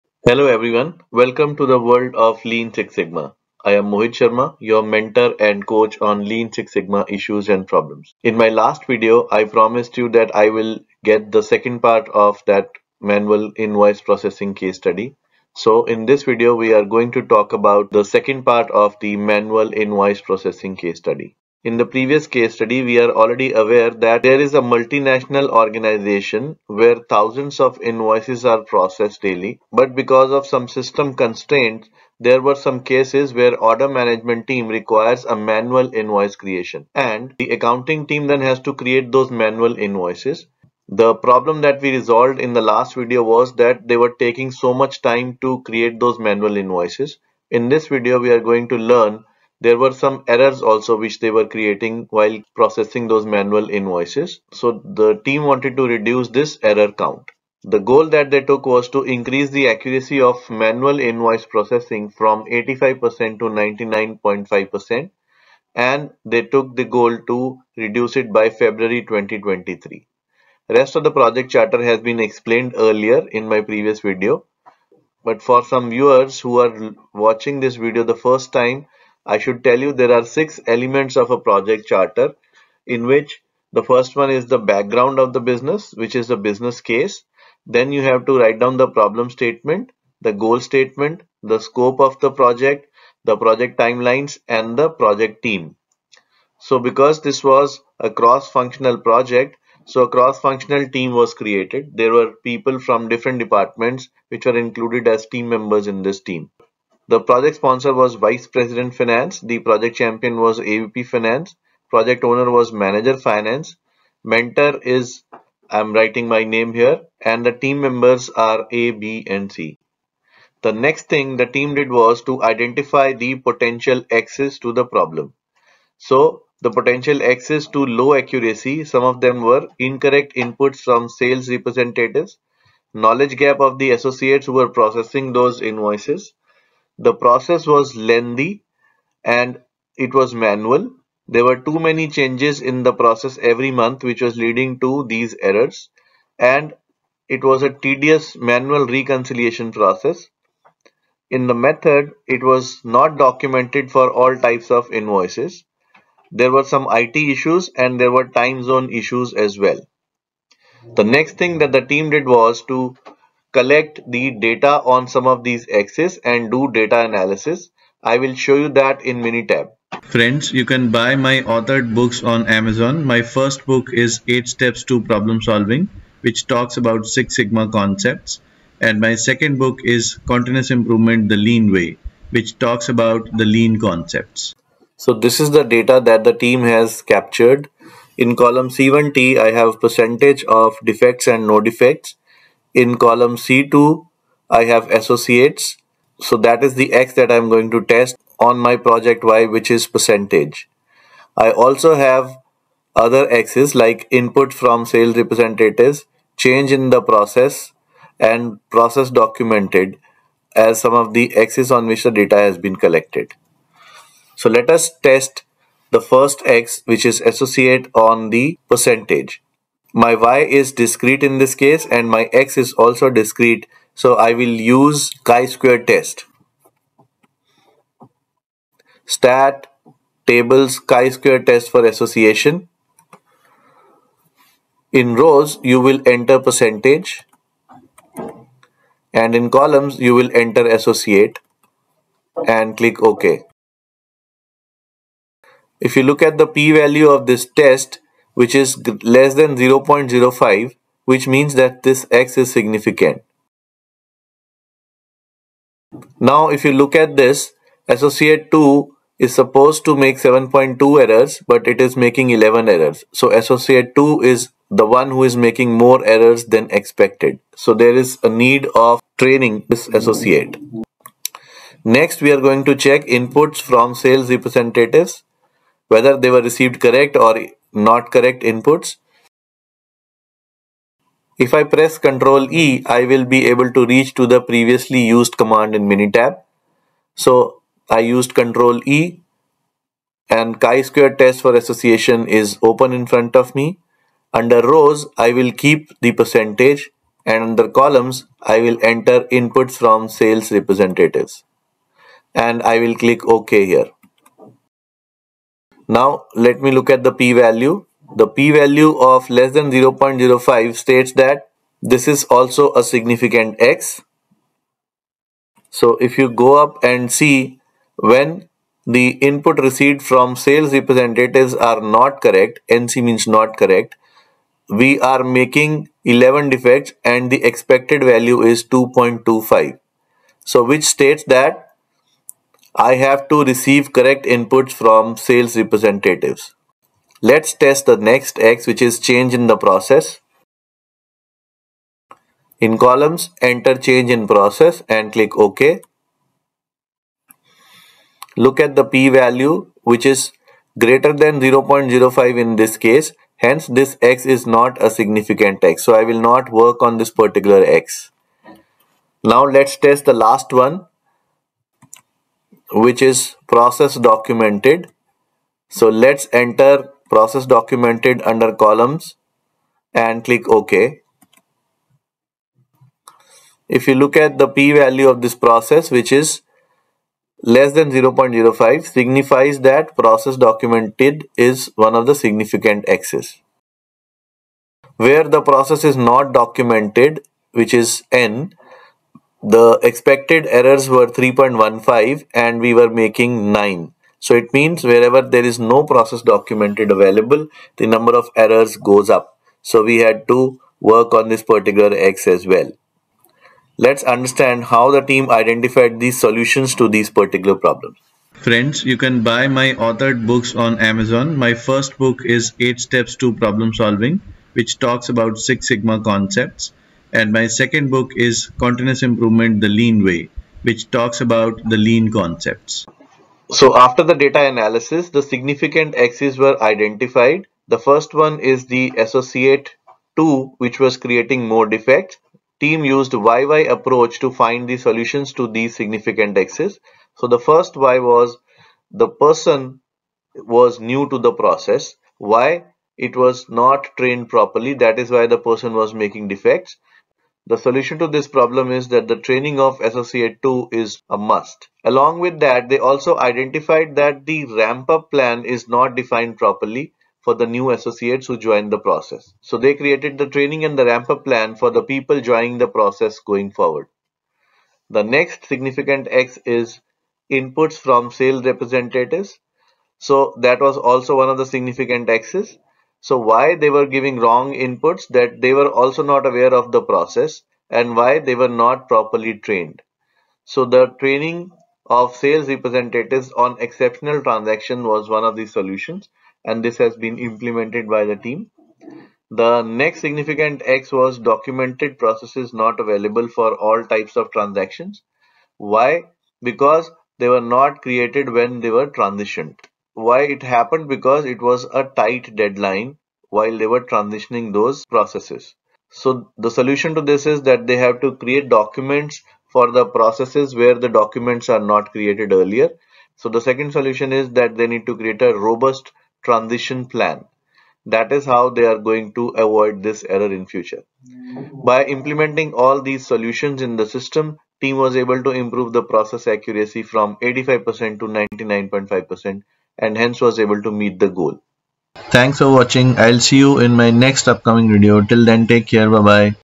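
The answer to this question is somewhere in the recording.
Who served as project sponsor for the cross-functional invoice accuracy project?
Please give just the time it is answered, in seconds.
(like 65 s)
108 s.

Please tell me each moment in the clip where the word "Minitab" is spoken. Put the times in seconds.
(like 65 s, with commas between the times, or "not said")
169 s, 285 s.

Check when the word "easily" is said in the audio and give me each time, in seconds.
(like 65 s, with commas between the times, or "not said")
not said.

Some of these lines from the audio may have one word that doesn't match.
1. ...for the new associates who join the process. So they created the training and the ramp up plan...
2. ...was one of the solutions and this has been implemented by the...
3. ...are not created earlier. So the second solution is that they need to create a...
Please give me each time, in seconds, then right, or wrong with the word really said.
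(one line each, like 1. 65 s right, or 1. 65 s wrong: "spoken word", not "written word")
1. 457 s right
2. 484 s right
3. 511 s right.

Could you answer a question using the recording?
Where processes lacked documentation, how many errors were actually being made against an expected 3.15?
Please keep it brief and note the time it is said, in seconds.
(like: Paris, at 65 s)
9, at 393 s.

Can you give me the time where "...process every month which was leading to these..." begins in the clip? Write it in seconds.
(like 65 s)
142 s.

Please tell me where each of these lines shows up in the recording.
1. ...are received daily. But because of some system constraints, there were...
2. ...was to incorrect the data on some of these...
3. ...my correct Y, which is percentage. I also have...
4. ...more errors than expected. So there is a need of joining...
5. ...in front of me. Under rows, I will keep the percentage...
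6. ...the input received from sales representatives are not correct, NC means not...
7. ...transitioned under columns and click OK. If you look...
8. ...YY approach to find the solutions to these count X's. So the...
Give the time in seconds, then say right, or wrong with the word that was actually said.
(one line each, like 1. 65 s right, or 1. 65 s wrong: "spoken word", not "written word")
1. 28 s wrong: "processed", not "received"
2. 162 s wrong: "collect", not "incorrect"
3. 198 s wrong: "project", not "correct"
4. 265 s wrong: "training", not "joining"
5. 292 s right
6. 318 s right
7. 367 s wrong: "documented", not "transitioned"
8. 433 s wrong: "significant", not "count".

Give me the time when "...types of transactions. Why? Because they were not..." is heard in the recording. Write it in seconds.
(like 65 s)
493 s.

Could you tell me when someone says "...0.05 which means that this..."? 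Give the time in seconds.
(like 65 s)
249 s.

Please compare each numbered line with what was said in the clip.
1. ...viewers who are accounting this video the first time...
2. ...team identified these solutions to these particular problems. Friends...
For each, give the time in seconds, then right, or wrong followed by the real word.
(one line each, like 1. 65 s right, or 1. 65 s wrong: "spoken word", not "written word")
1. 75 s wrong: "watching", not "accounting"
2. 405 s right.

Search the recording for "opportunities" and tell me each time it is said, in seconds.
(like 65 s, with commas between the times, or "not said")
not said.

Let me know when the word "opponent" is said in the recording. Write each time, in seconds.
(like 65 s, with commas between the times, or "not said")
not said.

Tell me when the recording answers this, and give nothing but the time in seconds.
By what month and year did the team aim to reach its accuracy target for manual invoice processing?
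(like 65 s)
68 s.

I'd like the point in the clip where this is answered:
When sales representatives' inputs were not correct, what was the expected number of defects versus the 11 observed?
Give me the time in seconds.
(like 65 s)
328 s.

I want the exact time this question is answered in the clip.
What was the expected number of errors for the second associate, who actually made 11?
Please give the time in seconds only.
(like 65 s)
260 s.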